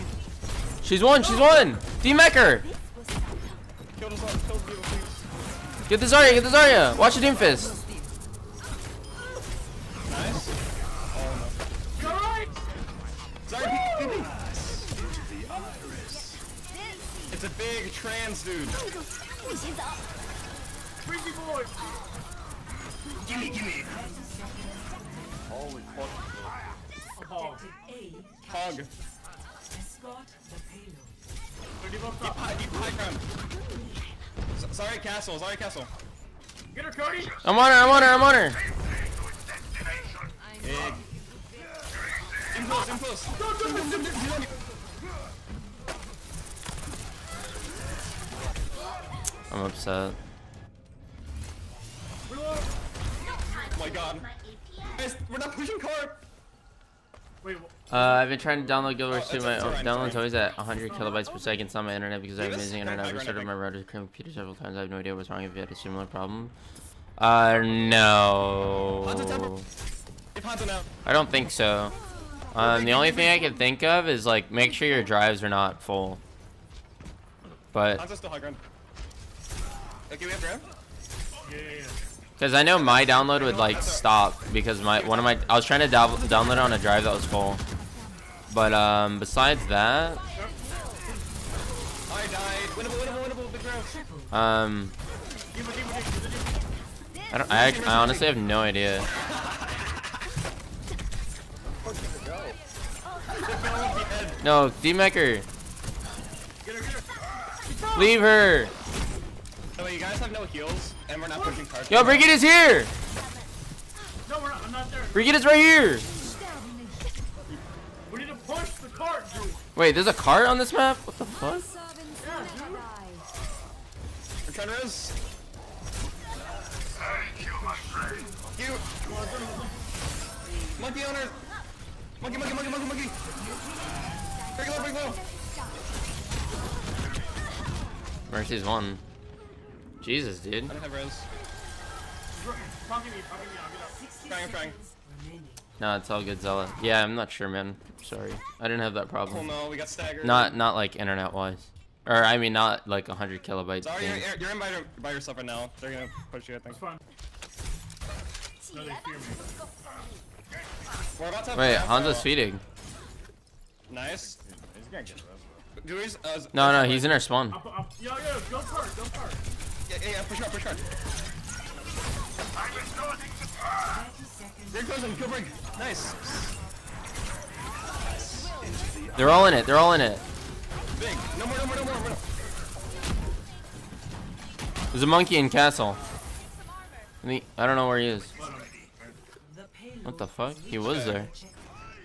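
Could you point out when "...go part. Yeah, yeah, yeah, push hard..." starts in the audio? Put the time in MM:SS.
02:48.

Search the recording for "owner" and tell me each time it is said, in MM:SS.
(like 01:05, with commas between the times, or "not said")
02:11.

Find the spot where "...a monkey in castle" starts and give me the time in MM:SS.
03:05.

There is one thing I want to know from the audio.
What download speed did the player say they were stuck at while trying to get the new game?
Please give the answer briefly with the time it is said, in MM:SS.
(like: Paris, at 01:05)
100 kilobytes per second, at 01:00.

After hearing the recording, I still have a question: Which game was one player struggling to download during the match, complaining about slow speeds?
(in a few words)
Guild Wars 2.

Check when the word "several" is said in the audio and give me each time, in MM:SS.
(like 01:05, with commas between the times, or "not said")
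01:04.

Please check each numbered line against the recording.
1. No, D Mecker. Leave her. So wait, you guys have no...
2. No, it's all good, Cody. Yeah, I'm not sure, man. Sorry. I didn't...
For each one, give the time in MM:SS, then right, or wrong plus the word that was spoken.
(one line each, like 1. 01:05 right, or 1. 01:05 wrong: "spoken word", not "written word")
1. 01:44 right
2. 02:25 wrong: "Zella", not "Cody".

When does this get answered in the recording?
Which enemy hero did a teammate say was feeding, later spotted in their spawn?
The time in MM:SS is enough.
02:41.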